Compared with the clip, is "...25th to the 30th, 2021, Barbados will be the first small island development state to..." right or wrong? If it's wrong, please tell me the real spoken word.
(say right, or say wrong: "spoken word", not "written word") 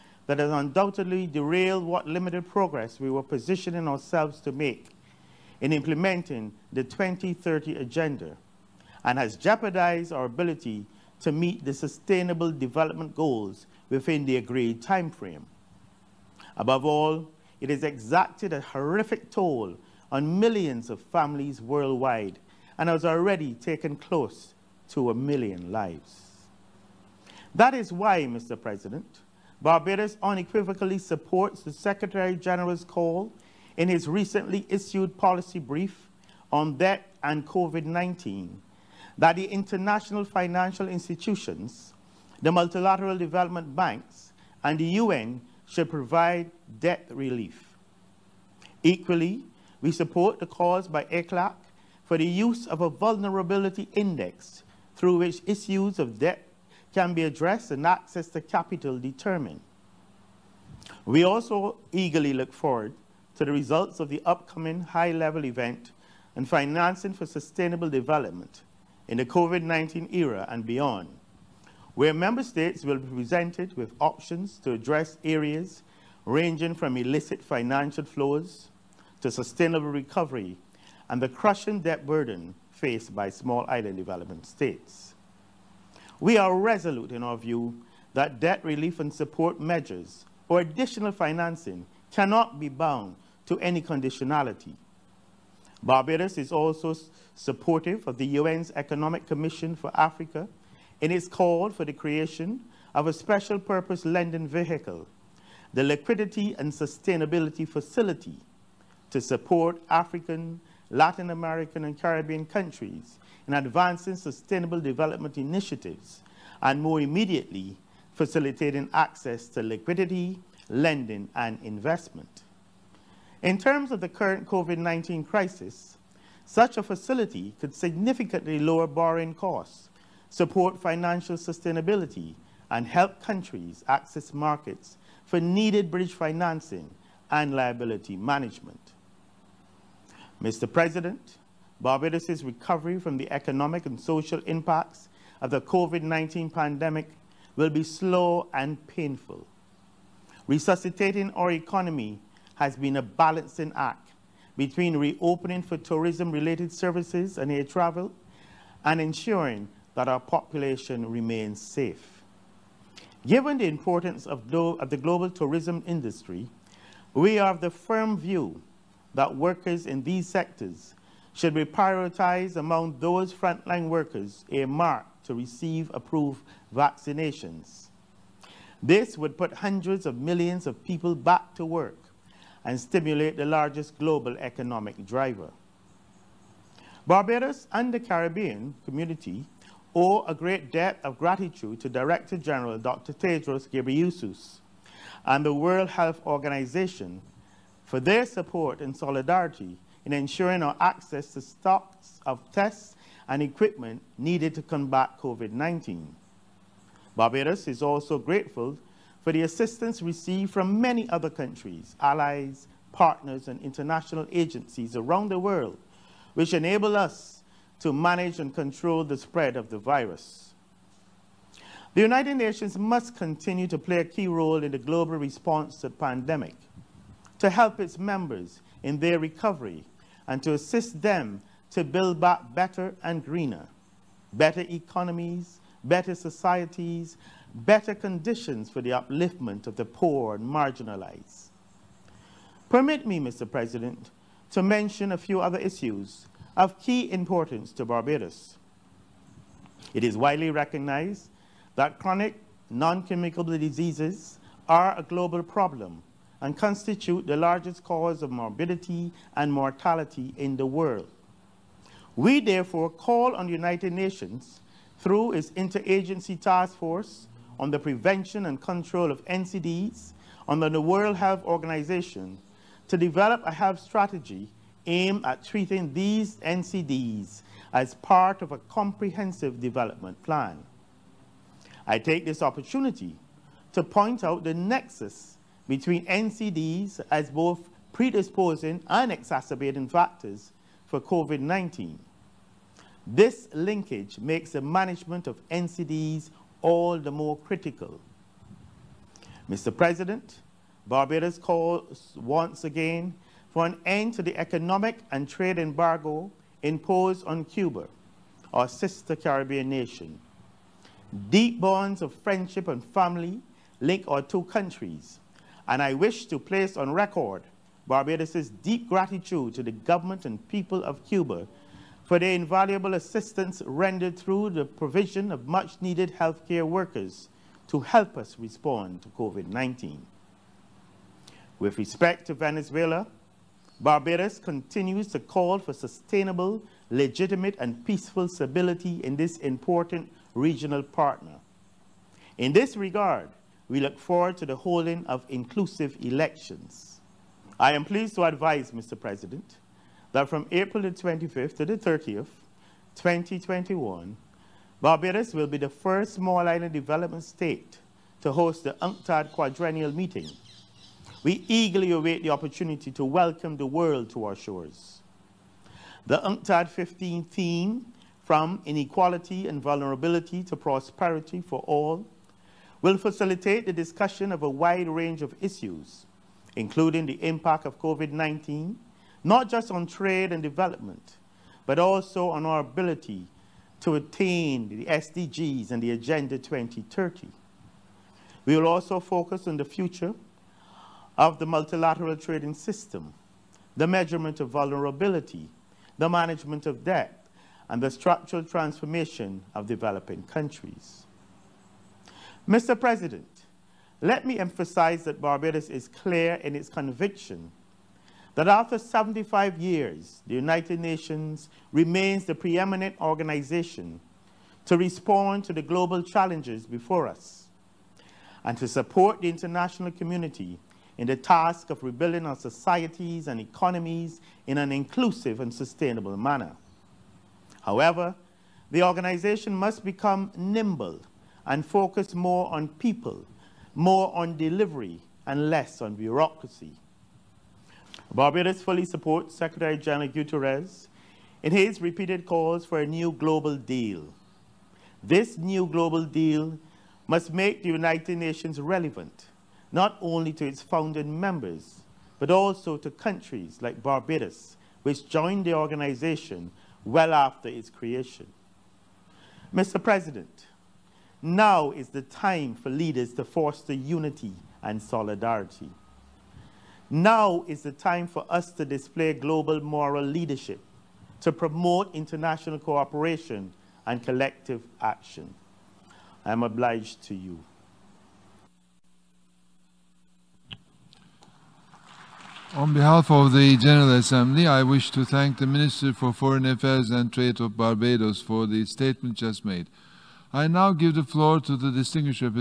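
right.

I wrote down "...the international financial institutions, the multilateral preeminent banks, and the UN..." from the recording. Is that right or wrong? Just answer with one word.
wrong.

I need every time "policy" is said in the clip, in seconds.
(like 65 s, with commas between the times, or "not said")
35 s.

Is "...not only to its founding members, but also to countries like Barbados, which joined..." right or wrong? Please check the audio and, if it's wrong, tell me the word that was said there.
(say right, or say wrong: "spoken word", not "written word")
right.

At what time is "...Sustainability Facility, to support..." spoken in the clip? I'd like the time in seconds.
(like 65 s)
106 s.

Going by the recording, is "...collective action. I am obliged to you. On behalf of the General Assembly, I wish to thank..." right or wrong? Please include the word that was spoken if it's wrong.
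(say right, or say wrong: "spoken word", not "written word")
right.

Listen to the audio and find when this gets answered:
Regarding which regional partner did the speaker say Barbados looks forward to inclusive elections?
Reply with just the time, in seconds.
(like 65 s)
332 s.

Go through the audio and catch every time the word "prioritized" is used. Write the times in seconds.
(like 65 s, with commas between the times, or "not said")
171 s.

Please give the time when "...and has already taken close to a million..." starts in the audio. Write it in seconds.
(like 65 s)
22 s.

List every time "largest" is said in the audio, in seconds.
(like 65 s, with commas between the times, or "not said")
183 s, 257 s.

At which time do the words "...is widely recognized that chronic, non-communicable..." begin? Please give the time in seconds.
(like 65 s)
250 s.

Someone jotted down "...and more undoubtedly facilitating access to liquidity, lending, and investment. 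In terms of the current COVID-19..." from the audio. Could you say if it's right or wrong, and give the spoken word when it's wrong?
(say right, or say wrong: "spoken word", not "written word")
wrong: "immediately", not "undoubtedly".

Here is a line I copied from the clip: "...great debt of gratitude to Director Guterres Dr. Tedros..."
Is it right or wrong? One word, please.
wrong.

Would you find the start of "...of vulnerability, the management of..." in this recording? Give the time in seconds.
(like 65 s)
394 s.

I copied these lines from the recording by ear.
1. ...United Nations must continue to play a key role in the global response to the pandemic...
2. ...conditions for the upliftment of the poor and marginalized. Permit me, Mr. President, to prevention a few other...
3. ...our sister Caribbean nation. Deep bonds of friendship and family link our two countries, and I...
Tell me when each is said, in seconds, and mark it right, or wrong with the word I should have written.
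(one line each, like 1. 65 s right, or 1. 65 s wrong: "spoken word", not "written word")
1. 222 s right
2. 237 s wrong: "mention", not "prevention"
3. 308 s right.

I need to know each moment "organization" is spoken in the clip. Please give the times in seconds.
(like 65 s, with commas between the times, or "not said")
196 s, 271 s, 413 s, 428 s, 455 s.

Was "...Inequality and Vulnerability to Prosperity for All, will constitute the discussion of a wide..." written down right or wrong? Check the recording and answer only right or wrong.
wrong.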